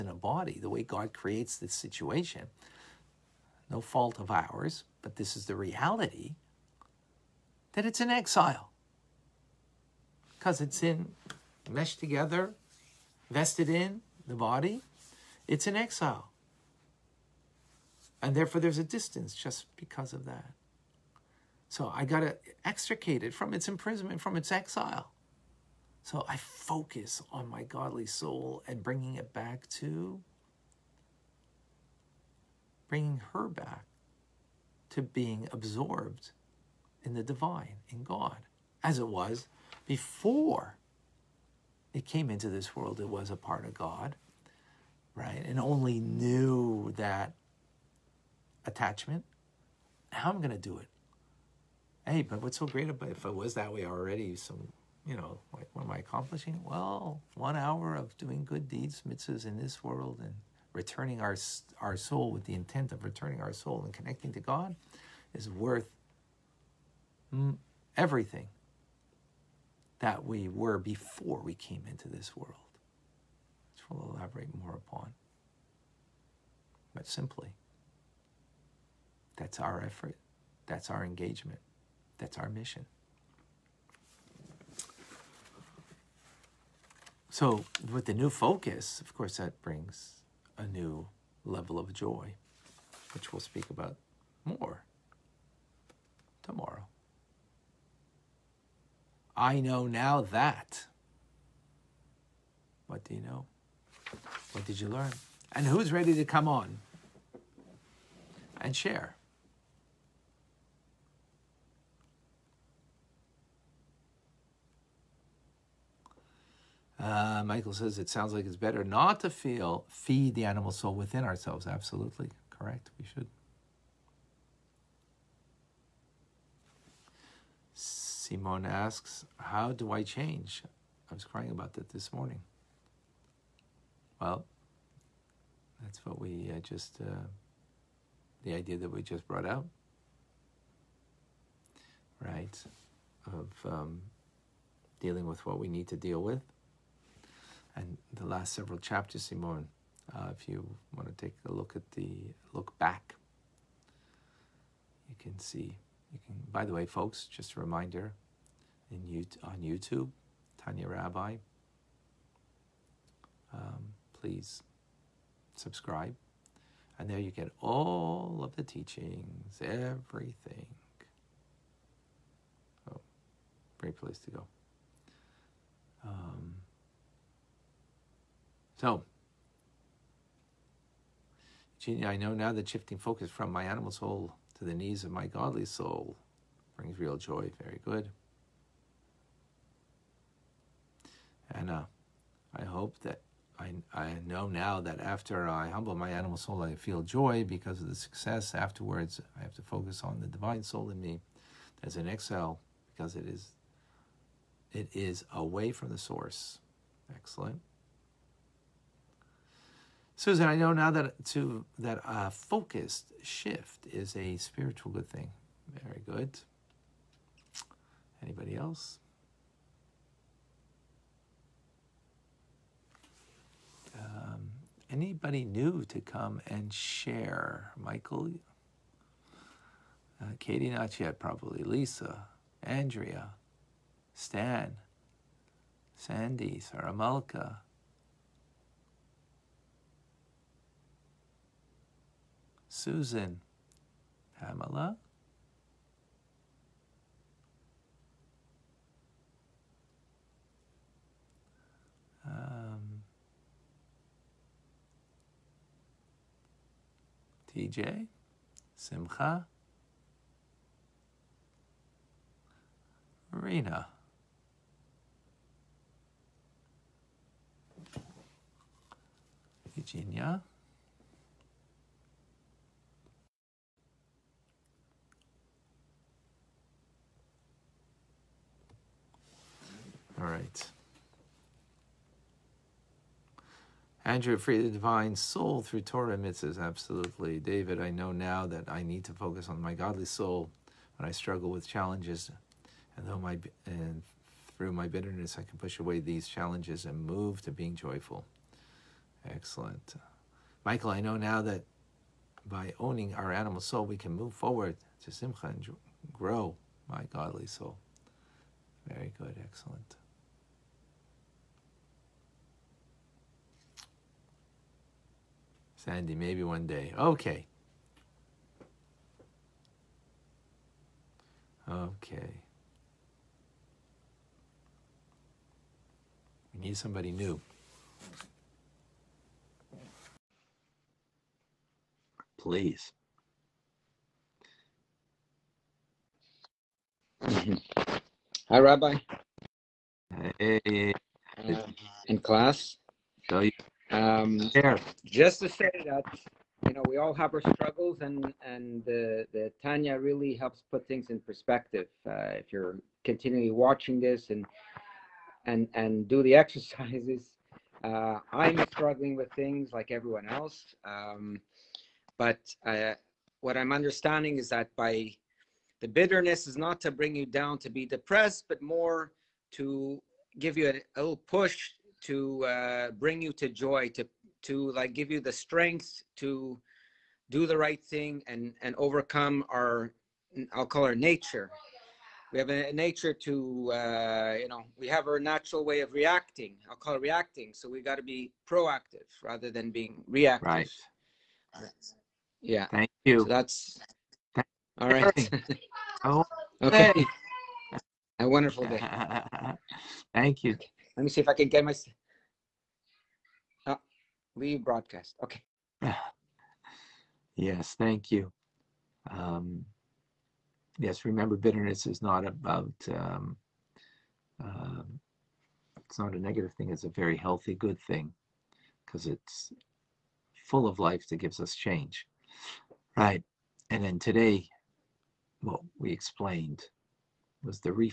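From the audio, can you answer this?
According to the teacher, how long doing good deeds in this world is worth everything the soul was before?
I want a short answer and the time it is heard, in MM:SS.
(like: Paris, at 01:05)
One hour, at 00:57.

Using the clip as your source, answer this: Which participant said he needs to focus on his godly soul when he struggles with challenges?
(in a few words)
David.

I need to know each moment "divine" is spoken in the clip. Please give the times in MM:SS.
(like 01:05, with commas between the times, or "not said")
00:37, 03:20, 04:44.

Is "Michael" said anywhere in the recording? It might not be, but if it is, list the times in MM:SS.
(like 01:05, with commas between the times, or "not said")
01:57, 03:47, 05:00.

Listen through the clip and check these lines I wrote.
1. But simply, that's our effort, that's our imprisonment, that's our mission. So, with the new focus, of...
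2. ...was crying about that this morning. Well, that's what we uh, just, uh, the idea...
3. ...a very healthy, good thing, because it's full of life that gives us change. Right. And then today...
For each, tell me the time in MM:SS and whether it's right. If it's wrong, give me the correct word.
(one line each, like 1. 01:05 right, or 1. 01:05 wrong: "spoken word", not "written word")
1. 01:16 wrong: "engagement", not "imprisonment"
2. 02:11 right
3. 06:56 right.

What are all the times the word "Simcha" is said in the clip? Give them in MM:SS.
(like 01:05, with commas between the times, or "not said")
04:18, 05:05.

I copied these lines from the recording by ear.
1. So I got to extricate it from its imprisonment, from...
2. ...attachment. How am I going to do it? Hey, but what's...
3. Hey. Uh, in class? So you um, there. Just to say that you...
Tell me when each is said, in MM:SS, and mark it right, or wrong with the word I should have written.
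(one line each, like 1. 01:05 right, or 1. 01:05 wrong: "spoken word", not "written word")
1. 00:21 right
2. 00:48 right
3. 05:40 right.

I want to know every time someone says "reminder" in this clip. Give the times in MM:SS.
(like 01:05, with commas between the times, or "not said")
02:37.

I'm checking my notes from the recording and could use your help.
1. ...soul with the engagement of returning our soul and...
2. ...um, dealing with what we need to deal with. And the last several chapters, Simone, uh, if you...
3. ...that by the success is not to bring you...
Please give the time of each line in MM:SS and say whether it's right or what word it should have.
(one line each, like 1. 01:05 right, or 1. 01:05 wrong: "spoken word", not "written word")
1. 01:01 wrong: "intent", not "engagement"
2. 02:23 right
3. 06:04 wrong: "bitterness", not "success".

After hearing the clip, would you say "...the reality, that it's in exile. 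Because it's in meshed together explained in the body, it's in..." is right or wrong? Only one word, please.
wrong.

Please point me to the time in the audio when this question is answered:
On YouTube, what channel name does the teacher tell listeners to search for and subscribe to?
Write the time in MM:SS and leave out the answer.
02:40.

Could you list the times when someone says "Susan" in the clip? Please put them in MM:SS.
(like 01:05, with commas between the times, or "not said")
03:30, 04:02.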